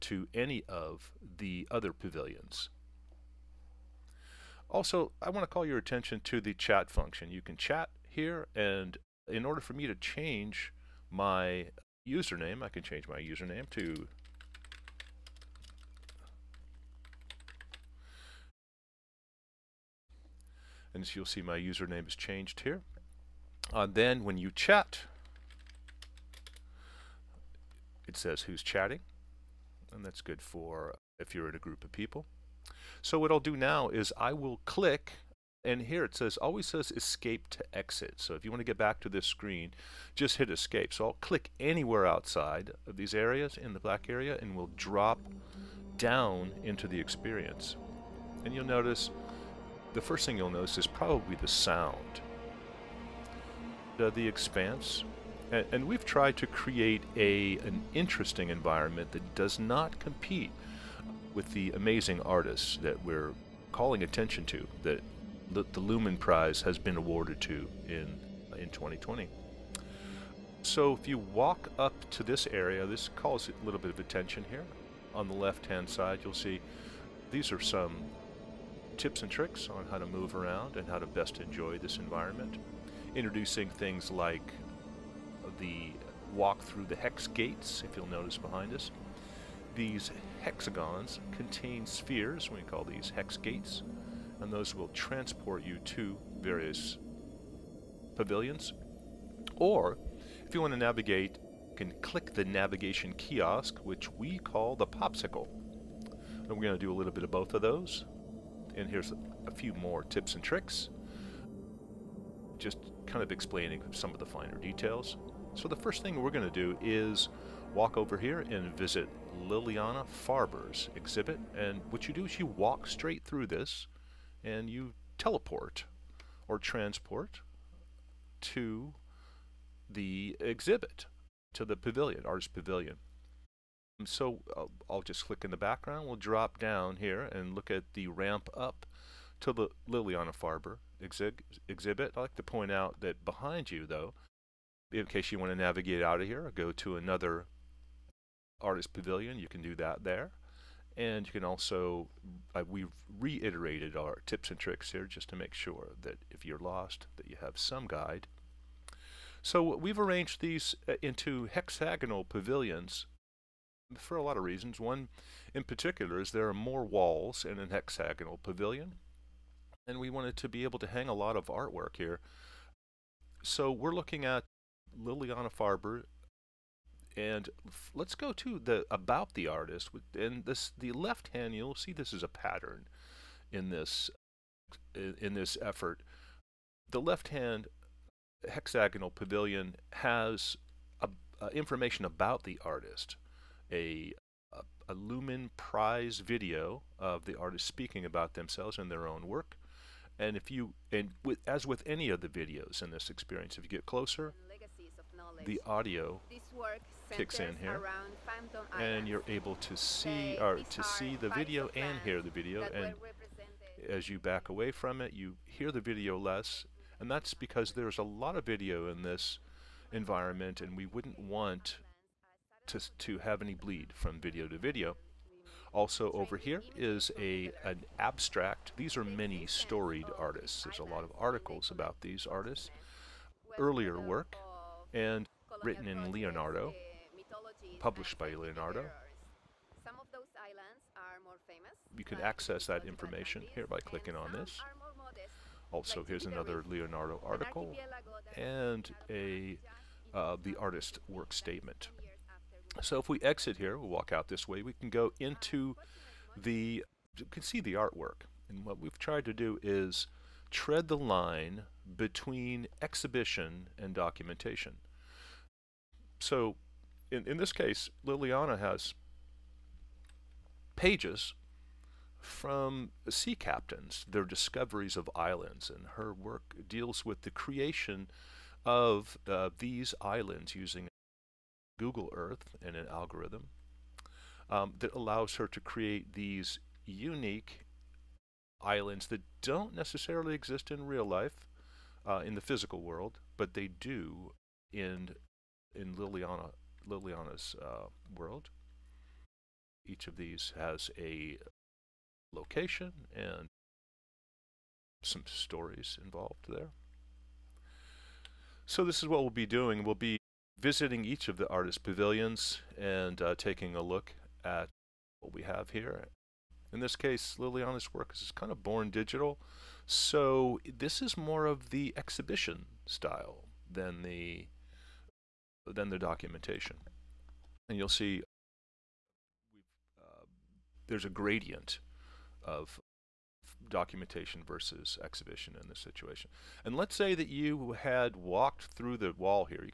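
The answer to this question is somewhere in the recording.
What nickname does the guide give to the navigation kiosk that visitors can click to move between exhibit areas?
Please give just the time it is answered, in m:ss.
1:44.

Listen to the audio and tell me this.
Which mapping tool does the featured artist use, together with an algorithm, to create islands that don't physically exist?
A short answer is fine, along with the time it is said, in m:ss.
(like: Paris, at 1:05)
Google Earth, at 4:41.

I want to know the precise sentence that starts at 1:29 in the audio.
These hexagons contain spheres, we call these hex gates, and those will transport you to various pavilions.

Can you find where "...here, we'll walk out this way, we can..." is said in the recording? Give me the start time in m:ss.
4:13.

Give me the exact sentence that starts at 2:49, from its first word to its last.
And we wanted to be able to hang a lot of artwork here.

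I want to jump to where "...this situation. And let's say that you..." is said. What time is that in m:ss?
5:35.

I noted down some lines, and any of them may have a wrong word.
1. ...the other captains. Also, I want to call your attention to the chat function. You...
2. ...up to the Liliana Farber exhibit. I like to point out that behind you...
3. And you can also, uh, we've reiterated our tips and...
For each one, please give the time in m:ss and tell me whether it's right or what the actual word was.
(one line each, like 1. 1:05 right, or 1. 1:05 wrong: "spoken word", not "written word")
1. 0:01 wrong: "pavilions", not "captains"
2. 2:18 right
3. 2:30 right.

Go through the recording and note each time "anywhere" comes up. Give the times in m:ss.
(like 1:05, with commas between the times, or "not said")
0:41.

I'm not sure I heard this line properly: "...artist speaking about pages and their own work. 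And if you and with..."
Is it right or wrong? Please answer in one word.
wrong.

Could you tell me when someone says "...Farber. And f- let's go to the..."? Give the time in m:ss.
2:55.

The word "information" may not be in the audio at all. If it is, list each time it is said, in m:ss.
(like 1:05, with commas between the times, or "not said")
3:11, 4:02.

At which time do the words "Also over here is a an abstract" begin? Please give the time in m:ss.
3:45.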